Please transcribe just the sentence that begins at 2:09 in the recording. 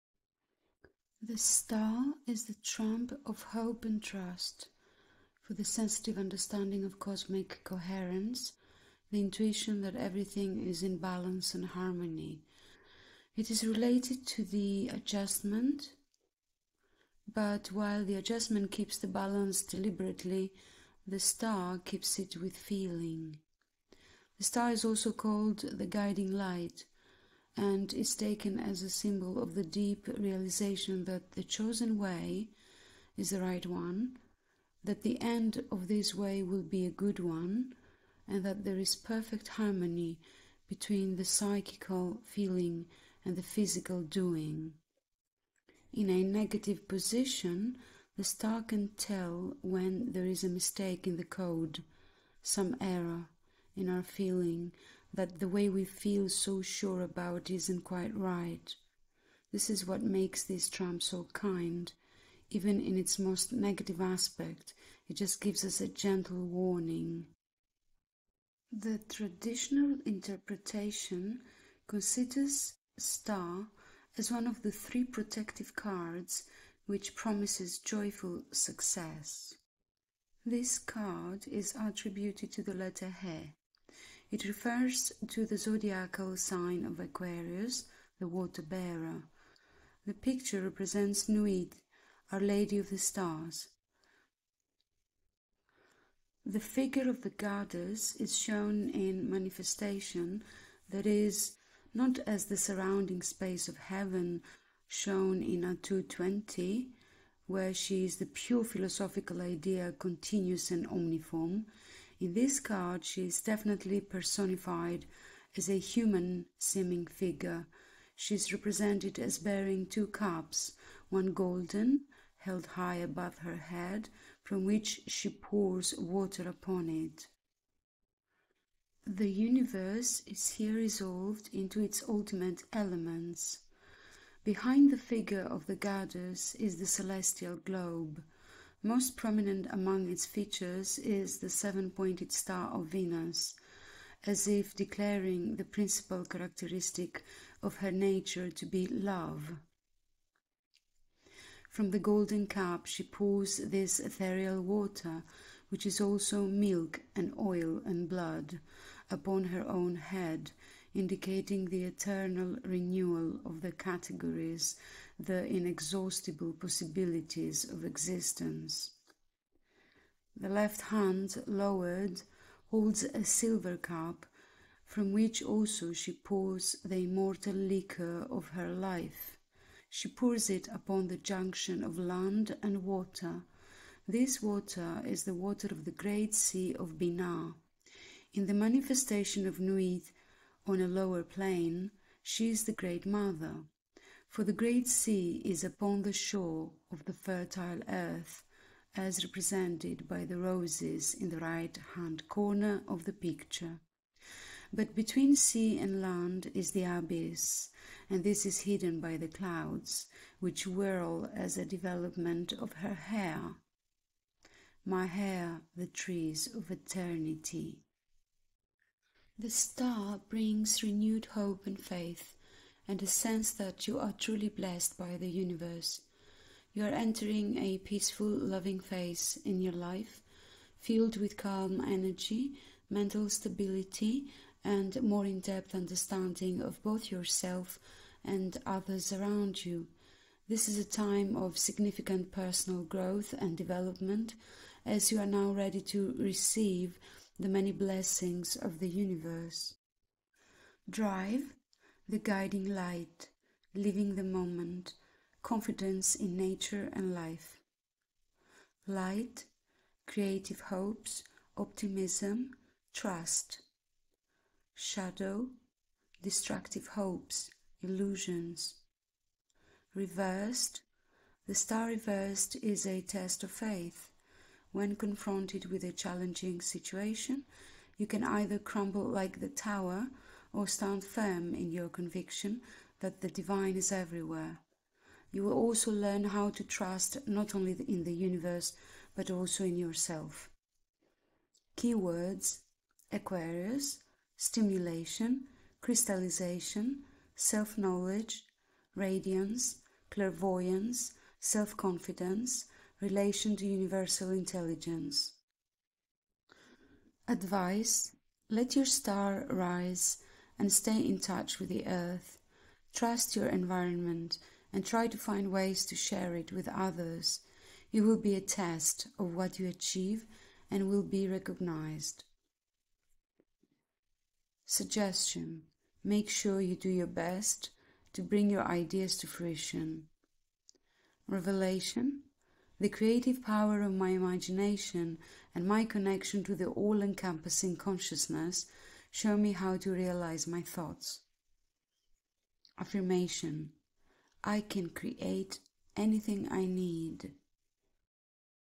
The universe is here resolved into its ultimate elements.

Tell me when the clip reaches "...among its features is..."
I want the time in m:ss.
2:19.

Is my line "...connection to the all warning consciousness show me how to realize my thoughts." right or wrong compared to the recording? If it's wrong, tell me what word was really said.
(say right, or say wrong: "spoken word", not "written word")
wrong: "encompassing", not "warning".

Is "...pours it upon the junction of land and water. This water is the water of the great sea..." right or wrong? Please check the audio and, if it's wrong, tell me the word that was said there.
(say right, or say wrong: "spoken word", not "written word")
right.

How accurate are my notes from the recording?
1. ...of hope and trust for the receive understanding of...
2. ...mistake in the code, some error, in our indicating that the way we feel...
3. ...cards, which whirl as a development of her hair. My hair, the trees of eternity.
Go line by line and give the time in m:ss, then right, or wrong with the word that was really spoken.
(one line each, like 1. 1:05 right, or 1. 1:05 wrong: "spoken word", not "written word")
1. 0:03 wrong: "sensitive", not "receive"
2. 0:50 wrong: "feeling", not "indicating"
3. 3:29 wrong: "clouds", not "cards".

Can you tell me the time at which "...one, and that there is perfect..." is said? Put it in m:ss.
0:37.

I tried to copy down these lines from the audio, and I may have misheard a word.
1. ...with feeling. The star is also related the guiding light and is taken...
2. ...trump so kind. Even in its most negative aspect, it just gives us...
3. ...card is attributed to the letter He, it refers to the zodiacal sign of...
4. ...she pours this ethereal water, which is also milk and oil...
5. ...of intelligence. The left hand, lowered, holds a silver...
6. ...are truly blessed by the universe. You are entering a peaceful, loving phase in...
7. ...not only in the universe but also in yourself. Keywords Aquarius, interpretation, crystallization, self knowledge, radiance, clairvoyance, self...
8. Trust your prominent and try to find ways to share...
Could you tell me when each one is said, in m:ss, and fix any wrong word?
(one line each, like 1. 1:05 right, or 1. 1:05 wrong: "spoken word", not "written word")
1. 0:22 wrong: "called", not "related"
2. 1:00 right
3. 1:20 right
4. 2:32 right
5. 2:47 wrong: "existence", not "intelligence"
6. 3:43 right
7. 4:47 wrong: "stimulation", not "interpretation"
8. 5:12 wrong: "environment", not "prominent".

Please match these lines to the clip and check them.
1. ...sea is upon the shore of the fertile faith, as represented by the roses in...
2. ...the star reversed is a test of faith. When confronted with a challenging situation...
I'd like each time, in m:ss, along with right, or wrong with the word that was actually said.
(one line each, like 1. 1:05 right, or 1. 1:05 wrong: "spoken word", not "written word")
1. 3:14 wrong: "earth", not "faith"
2. 4:31 right.